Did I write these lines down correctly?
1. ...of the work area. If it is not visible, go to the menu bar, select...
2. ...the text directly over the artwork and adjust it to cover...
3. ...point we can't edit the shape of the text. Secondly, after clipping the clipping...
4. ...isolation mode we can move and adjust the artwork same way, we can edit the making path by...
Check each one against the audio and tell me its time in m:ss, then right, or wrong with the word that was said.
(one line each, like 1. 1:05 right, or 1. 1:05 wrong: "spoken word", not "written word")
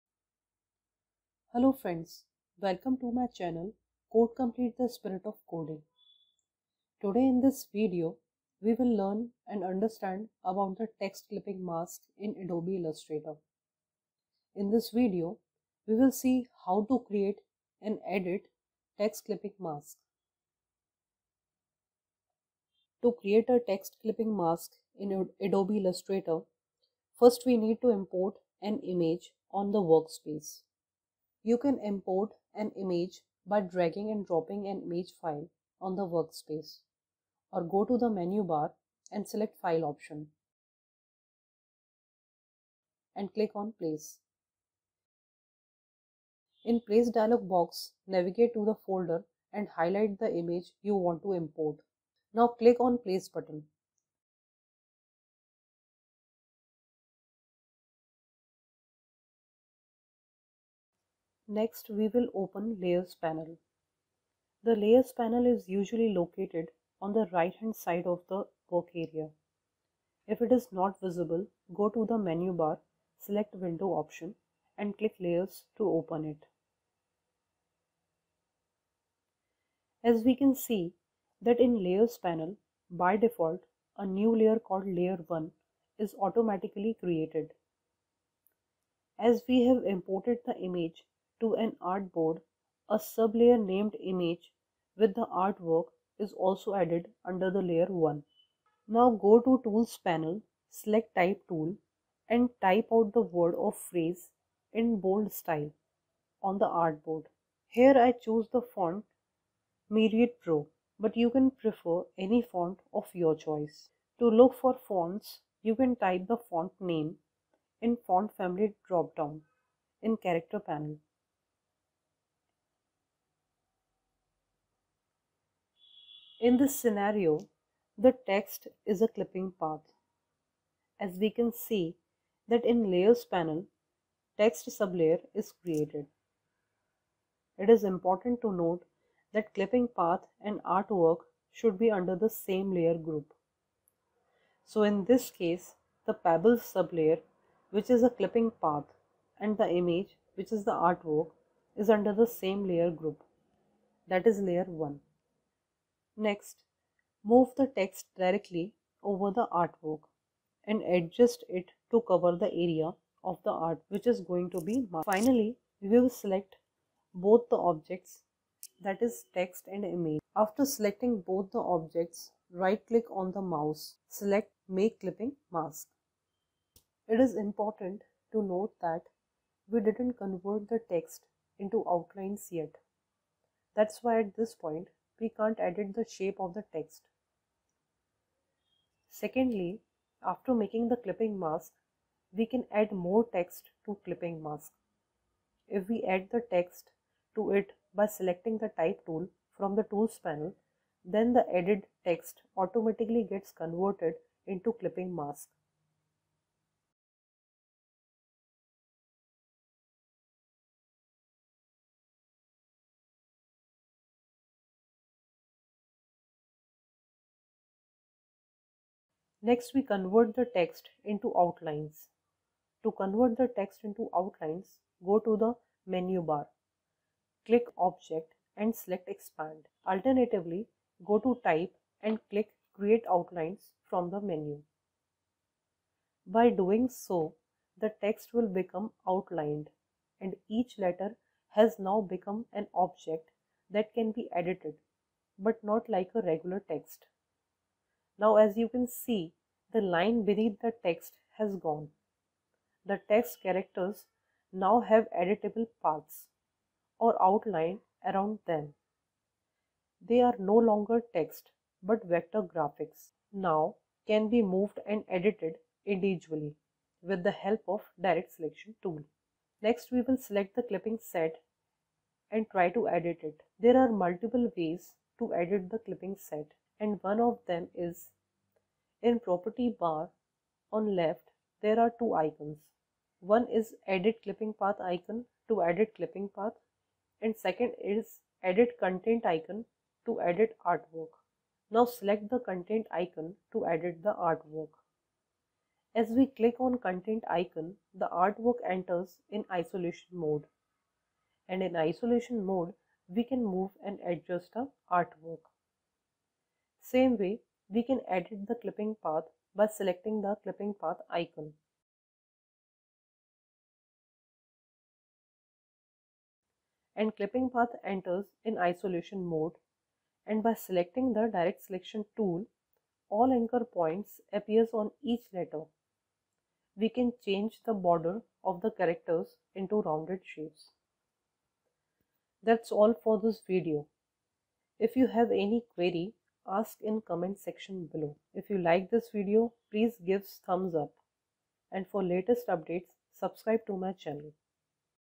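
1. 1:08 right
2. 2:37 right
3. 3:04 wrong: "making", not "clipping"
4. 5:01 wrong: "clipping", not "making".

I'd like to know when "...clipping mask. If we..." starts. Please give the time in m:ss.
3:14.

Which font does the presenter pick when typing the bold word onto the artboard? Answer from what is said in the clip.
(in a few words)
Myriad Pro.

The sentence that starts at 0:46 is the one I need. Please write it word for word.
In place dialog box, navigate to the folder and highlight the image you want to import.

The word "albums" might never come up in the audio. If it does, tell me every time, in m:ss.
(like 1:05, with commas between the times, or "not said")
not said.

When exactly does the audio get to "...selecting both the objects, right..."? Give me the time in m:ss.
2:50.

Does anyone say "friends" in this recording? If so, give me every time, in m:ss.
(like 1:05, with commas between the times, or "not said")
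0:01.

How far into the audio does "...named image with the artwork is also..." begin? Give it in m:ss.
1:33.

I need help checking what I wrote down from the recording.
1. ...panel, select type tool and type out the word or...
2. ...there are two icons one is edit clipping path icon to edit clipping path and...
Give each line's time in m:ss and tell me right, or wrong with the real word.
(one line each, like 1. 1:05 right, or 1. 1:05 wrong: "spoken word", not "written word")
1. 1:40 right
2. 4:41 right.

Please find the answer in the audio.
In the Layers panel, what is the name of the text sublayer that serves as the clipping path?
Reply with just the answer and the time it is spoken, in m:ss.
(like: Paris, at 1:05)
Pebble, at 2:26.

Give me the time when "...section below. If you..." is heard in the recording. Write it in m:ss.
5:37.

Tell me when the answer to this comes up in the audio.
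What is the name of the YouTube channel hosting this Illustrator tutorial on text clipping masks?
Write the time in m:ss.
0:04.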